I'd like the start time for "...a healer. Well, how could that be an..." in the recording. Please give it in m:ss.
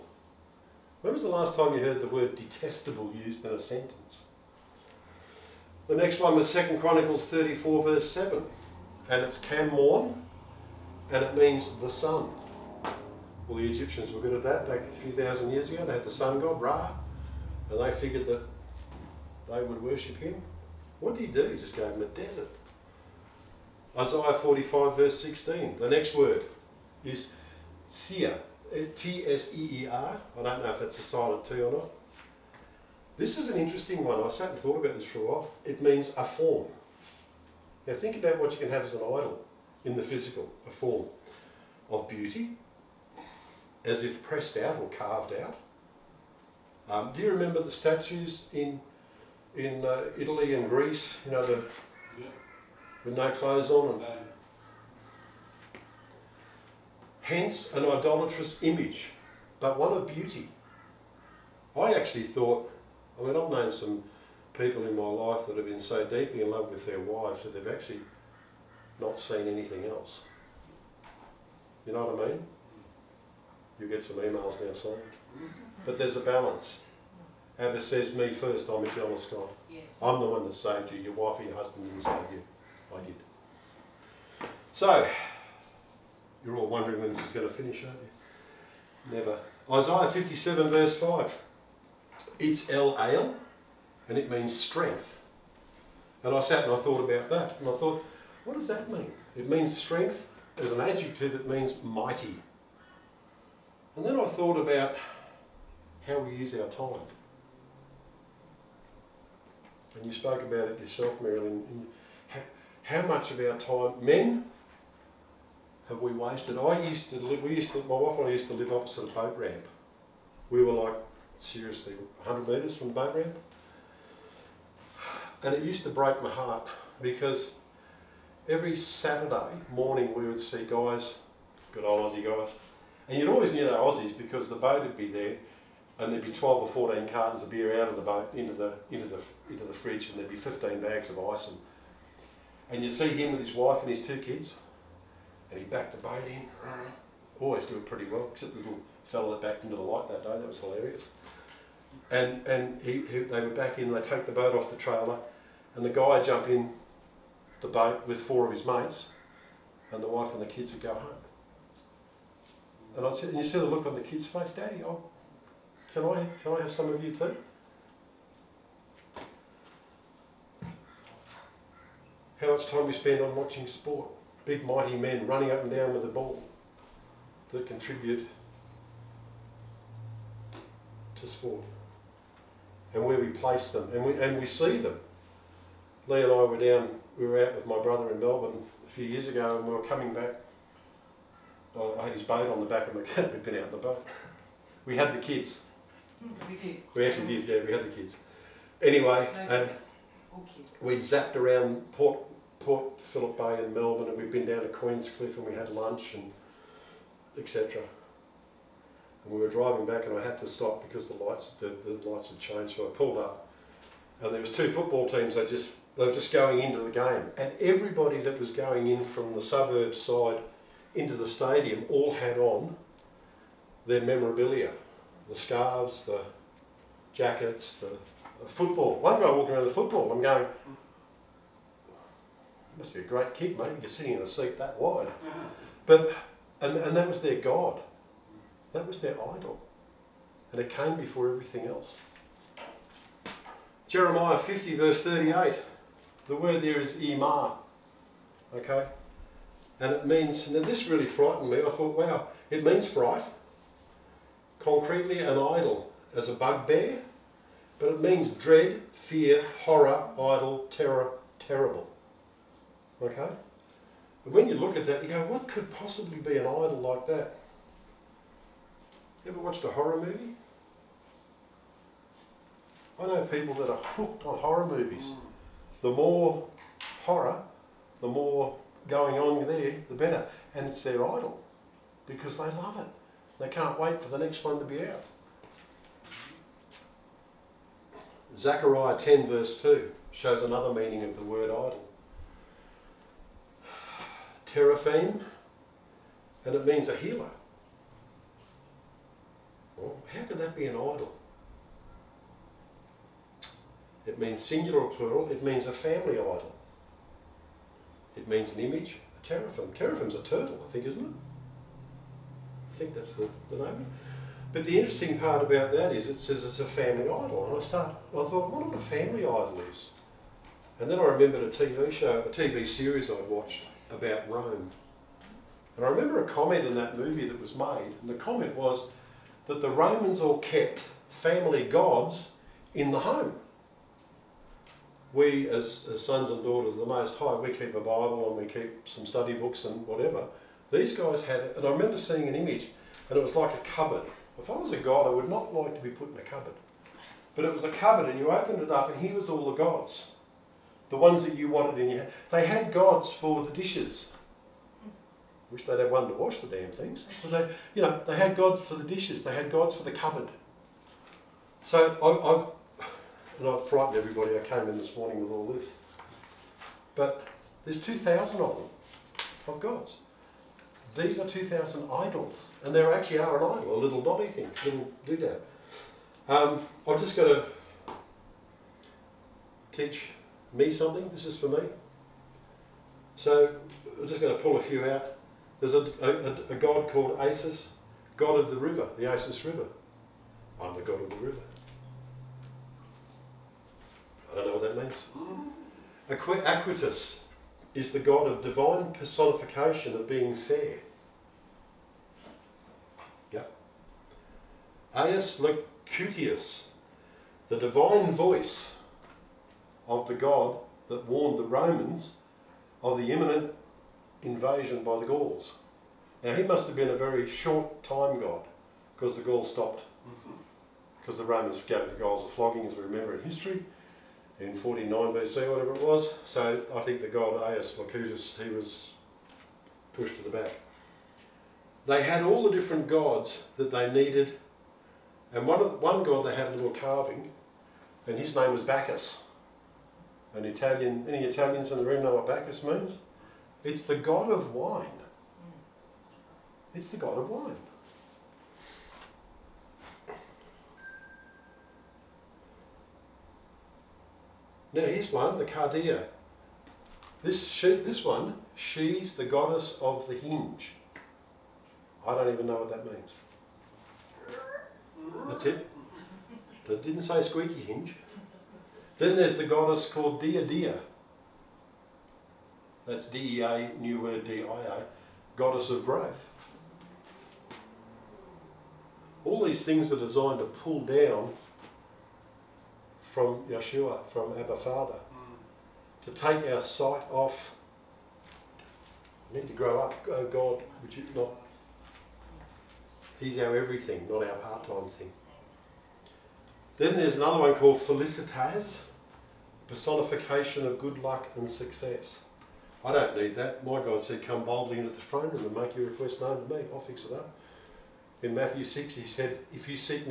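4:56.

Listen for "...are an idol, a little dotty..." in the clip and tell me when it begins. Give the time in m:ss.
6:13.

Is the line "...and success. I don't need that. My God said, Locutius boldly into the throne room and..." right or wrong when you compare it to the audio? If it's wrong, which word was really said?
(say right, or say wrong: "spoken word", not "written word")
wrong: "Come", not "Locutius".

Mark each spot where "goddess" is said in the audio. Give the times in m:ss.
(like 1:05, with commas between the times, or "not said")
7:39, 7:49, 7:55.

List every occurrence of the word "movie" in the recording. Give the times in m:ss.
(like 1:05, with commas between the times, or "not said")
4:30, 4:34, 5:26.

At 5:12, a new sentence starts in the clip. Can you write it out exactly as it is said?
I think that's the, the name.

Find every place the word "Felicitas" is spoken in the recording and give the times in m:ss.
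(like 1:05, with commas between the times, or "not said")
8:17.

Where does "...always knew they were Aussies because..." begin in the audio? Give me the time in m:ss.
2:13.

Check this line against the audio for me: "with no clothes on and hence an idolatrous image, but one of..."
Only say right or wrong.
right.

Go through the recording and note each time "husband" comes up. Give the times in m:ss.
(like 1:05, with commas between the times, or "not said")
1:21.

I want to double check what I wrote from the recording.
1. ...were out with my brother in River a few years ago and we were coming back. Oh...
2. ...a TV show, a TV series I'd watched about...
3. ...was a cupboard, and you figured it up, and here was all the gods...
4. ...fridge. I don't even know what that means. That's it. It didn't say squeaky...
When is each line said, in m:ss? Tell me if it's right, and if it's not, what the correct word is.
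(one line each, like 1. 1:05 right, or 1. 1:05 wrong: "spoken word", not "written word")
1. 3:07 wrong: "Melbourne", not "River"
2. 5:21 right
3. 5:47 wrong: "opened", not "figured"
4. 7:40 wrong: "hinge", not "fridge".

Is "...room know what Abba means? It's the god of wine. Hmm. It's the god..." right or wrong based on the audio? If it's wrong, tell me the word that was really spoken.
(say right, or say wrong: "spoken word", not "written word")
wrong: "Bacchus", not "Abba".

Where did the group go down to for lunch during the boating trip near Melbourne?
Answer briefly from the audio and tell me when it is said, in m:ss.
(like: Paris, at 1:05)
Queenscliff, at 3:24.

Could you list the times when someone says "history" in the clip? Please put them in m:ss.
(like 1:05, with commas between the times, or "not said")
7:03.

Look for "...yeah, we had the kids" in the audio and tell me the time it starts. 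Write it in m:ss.
3:17.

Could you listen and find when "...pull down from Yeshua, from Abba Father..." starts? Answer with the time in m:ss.
8:00.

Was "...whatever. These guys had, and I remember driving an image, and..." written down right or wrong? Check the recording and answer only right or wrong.
wrong.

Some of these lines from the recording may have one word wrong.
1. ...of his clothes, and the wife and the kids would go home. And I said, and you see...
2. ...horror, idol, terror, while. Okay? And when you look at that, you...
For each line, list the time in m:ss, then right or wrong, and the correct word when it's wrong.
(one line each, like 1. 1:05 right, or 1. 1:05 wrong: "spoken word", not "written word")
1. 2:38 wrong: "mates", not "clothes"
2. 4:19 wrong: "terrible", not "while".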